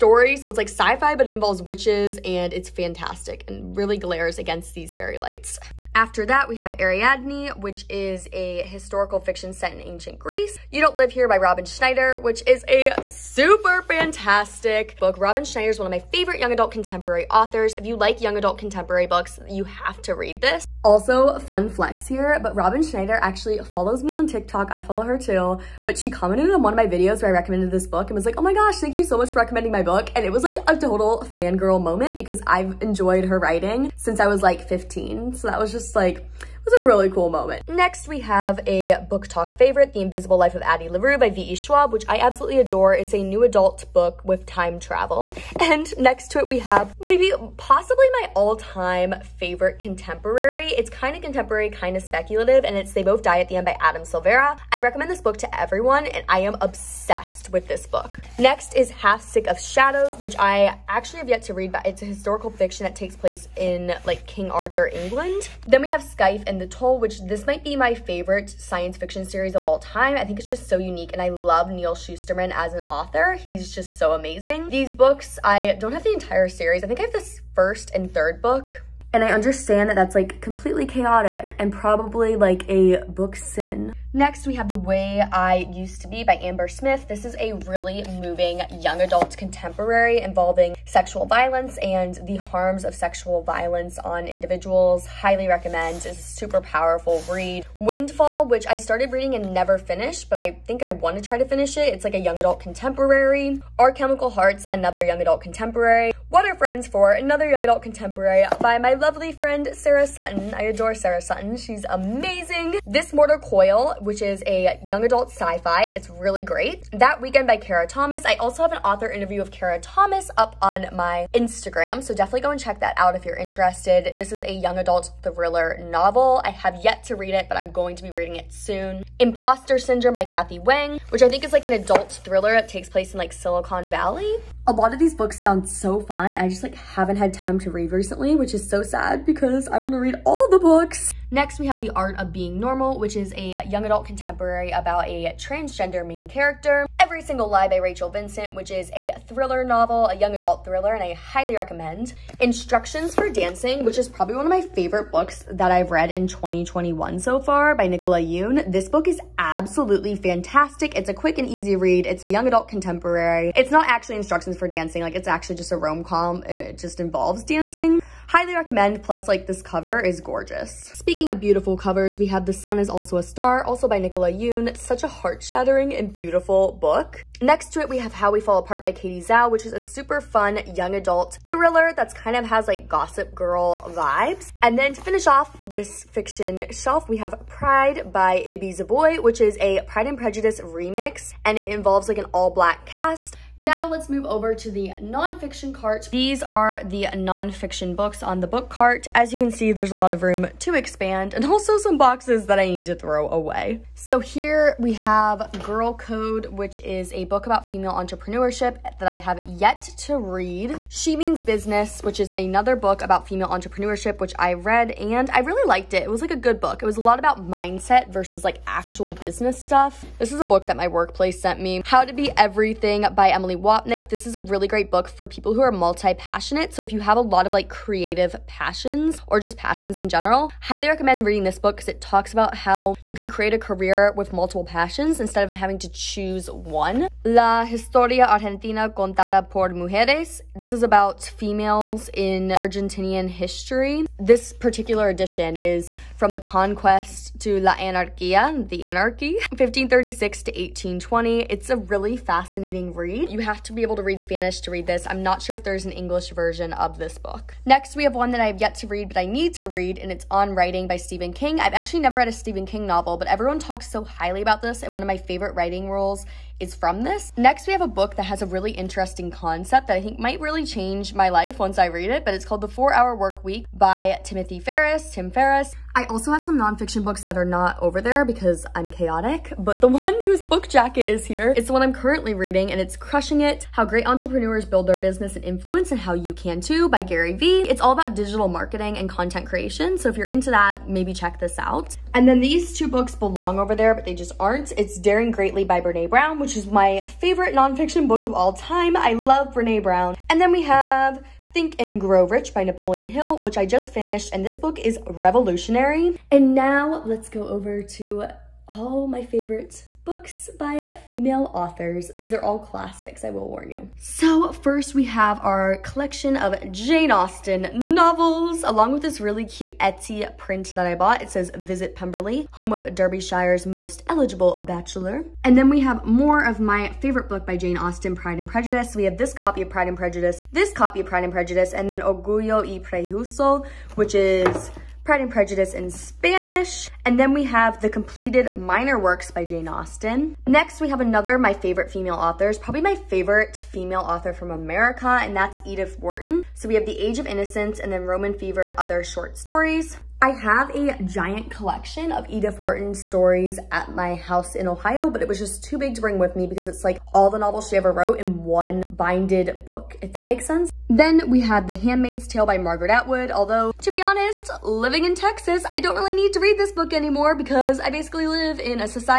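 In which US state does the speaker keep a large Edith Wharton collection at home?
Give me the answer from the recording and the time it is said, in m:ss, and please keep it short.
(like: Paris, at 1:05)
Ohio, at 5:54.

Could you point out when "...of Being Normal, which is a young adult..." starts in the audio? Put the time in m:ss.
2:22.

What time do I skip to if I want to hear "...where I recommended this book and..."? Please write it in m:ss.
0:27.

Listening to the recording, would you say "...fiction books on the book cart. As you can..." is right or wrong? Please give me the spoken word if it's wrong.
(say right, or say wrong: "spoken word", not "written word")
wrong: "nonfiction", not "fiction".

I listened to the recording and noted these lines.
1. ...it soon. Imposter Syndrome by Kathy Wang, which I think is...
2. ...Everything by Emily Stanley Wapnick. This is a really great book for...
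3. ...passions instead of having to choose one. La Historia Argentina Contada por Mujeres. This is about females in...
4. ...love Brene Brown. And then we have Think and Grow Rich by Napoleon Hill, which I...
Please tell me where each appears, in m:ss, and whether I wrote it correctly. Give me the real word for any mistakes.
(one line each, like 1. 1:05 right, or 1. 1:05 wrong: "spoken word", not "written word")
1. 2:08 right
2. 3:42 right
3. 3:54 right
4. 4:59 right.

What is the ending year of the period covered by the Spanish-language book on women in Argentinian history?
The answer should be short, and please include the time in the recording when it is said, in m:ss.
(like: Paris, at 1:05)
1820, at 4:10.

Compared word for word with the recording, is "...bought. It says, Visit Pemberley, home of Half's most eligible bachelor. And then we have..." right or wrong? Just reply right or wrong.
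wrong.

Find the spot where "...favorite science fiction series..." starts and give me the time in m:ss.
1:07.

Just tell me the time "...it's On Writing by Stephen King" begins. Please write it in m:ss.
4:20.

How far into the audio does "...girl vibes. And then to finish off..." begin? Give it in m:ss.
3:03.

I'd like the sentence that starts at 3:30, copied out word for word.
She Means Business, which is another book about female entrepreneurship, which I read and I really liked it.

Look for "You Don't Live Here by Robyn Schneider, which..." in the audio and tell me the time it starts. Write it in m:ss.
0:10.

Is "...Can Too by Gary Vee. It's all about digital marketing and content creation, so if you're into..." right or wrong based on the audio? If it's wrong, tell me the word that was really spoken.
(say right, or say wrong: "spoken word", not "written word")
right.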